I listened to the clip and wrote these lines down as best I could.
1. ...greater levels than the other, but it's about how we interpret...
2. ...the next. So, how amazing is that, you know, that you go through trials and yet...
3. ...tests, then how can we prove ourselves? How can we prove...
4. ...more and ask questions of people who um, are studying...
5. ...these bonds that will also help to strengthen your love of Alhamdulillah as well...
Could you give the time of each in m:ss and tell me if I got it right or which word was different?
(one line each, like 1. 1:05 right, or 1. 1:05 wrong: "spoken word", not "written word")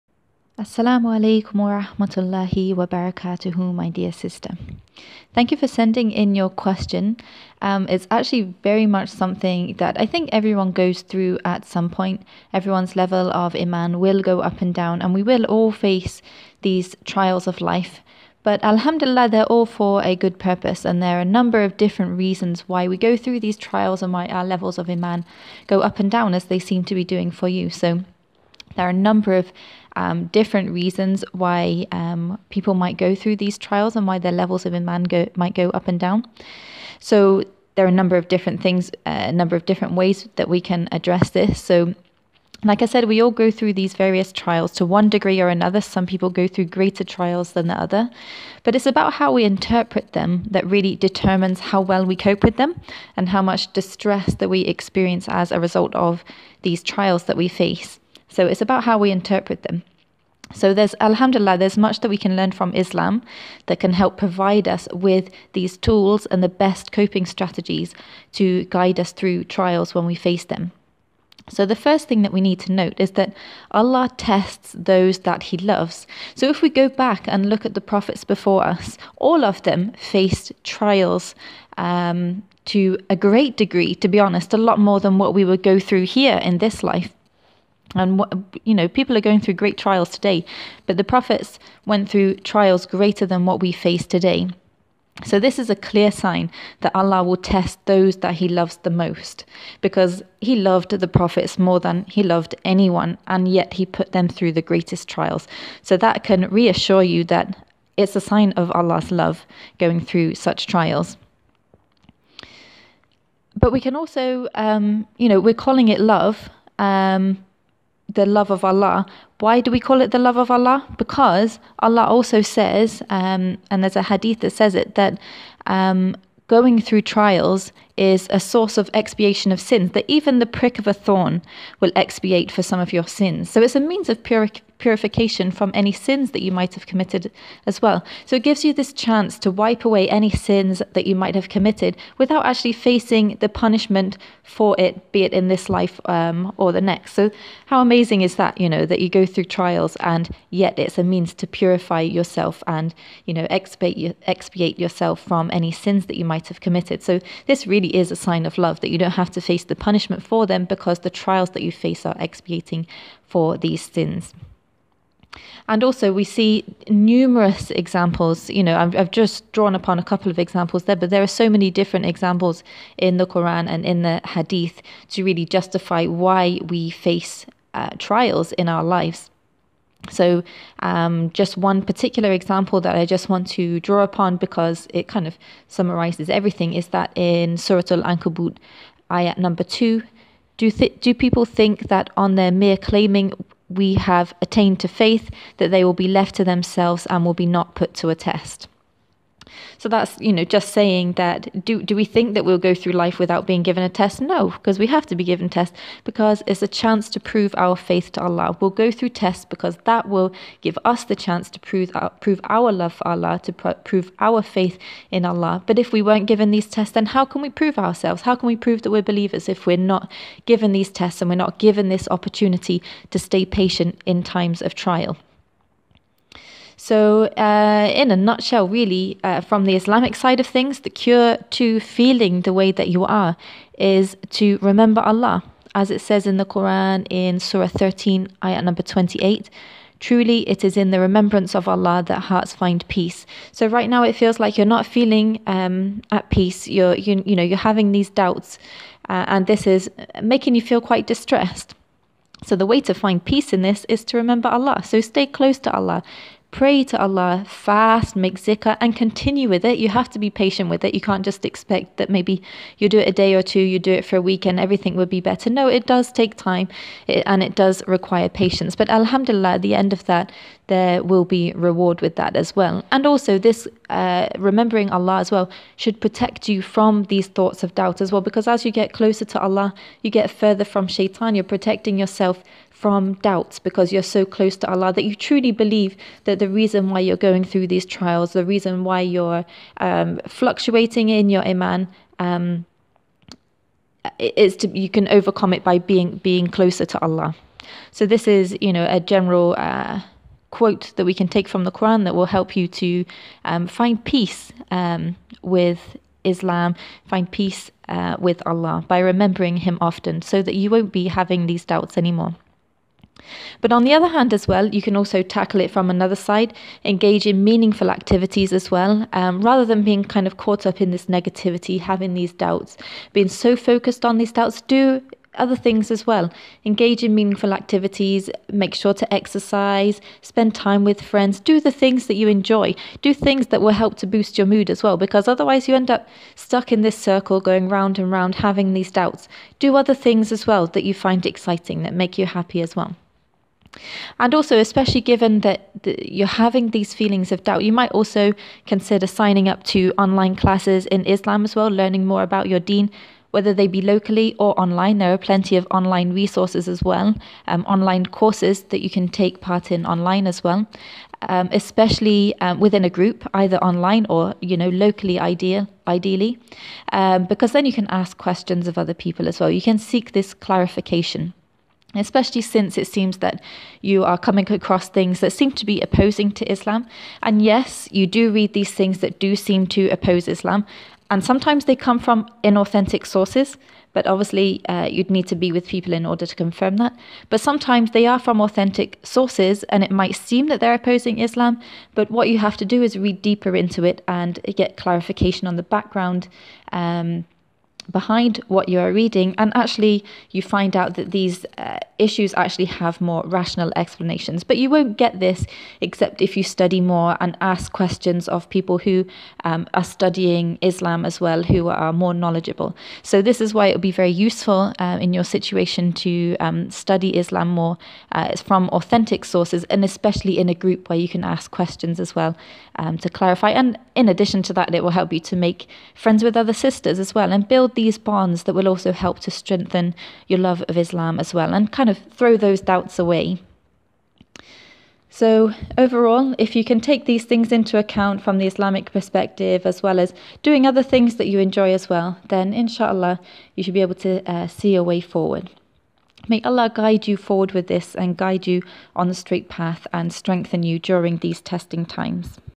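1. 0:46 wrong: "trials", not "levels"
2. 2:26 right
3. 3:36 right
4. 6:46 right
5. 7:07 wrong: "Islam", not "Alhamdulillah".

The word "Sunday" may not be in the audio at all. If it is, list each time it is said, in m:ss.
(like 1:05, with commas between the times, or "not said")
not said.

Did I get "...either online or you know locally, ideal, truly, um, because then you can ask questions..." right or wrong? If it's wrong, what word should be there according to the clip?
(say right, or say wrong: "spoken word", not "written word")
wrong: "ideally", not "truly".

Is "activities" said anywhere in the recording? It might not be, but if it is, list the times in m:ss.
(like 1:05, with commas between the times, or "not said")
5:17, 5:27.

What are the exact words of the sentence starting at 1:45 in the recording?
So, that can reassure you that it's a sign of Allah's love going through such trials.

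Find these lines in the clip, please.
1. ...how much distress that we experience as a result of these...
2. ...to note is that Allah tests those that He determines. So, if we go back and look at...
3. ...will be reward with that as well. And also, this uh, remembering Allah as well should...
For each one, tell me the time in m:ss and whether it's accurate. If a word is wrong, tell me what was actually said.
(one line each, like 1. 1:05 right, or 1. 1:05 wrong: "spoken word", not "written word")
1. 0:53 right
2. 1:12 wrong: "loves", not "determines"
3. 4:31 right.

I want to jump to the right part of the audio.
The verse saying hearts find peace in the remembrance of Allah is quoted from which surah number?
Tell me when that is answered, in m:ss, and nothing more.
3:57.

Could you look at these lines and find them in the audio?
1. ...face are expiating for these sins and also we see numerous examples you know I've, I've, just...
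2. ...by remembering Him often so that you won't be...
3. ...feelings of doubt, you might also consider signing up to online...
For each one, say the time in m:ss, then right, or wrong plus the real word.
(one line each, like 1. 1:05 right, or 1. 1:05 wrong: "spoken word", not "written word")
1. 2:41 right
2. 5:08 right
3. 5:46 right.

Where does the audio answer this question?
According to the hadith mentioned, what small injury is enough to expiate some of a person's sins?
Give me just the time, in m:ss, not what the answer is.
2:10.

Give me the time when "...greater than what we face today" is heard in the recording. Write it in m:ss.
1:32.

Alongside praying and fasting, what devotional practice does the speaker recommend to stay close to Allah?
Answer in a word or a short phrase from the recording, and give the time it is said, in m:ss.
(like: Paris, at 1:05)
zikr, at 4:18.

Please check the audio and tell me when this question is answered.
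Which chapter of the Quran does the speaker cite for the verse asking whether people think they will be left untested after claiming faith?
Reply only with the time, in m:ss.
3:07.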